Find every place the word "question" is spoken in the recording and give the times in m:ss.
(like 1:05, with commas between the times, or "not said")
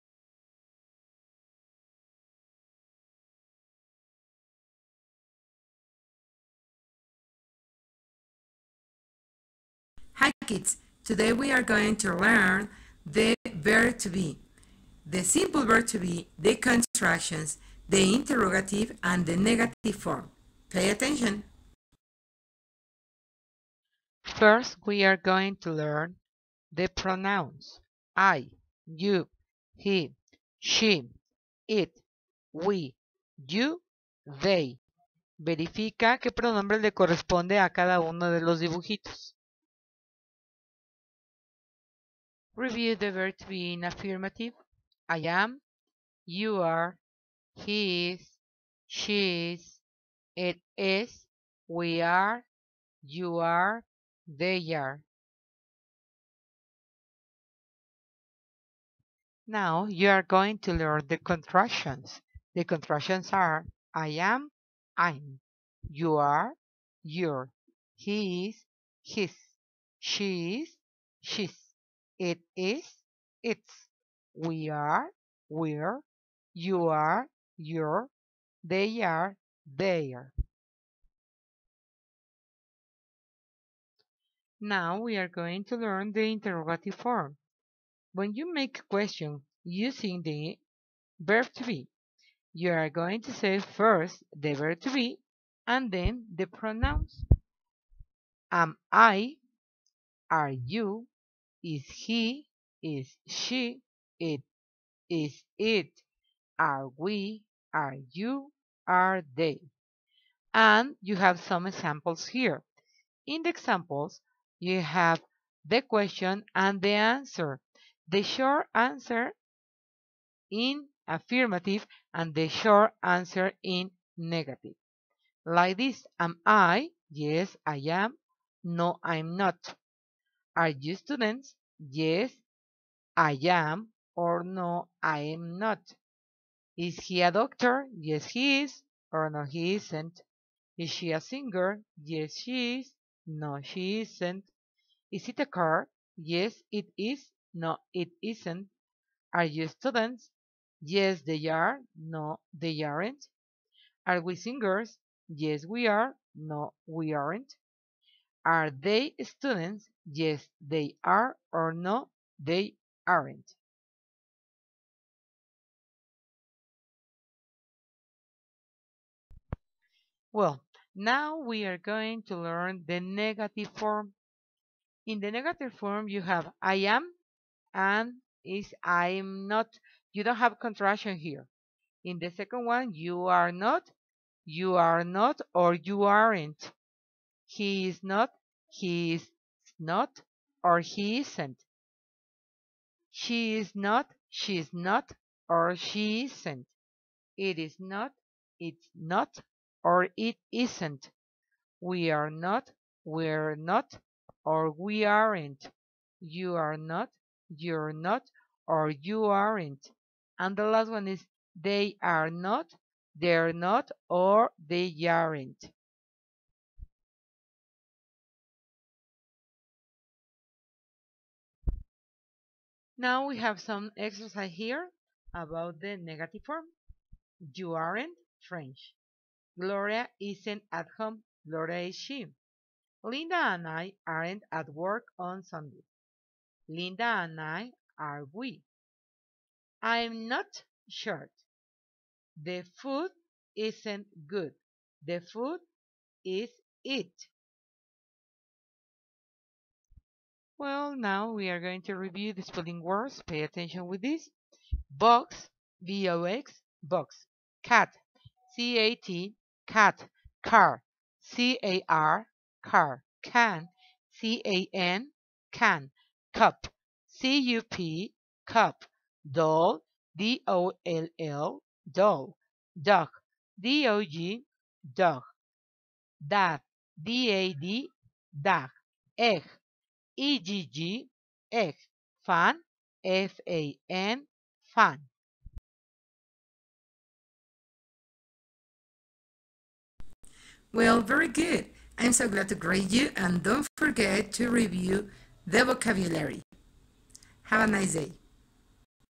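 1:28, 1:55.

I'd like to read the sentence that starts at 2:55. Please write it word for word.
In the negative form, you have I am, and is, I'm not.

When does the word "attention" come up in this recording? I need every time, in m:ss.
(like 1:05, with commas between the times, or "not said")
0:20, 4:13.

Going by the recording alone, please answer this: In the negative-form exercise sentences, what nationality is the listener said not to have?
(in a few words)
French.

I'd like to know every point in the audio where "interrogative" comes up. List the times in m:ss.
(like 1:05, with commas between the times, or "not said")
0:18, 1:26.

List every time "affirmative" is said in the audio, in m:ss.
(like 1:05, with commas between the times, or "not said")
0:43, 2:01.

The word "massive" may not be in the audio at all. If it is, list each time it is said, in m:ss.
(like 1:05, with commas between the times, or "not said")
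not said.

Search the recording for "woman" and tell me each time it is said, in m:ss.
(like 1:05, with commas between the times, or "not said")
not said.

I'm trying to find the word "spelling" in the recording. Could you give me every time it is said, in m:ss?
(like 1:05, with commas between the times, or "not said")
4:12.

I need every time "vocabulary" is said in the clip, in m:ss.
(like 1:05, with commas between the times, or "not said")
4:55.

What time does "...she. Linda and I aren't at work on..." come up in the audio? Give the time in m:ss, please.
3:51.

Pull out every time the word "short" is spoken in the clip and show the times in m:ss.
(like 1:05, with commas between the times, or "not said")
1:58, 2:02, 4:00.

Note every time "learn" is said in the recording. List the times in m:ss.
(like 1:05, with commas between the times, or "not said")
0:12, 0:25, 1:00, 1:25, 2:52.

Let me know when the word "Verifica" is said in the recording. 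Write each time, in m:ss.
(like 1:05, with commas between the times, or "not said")
0:35.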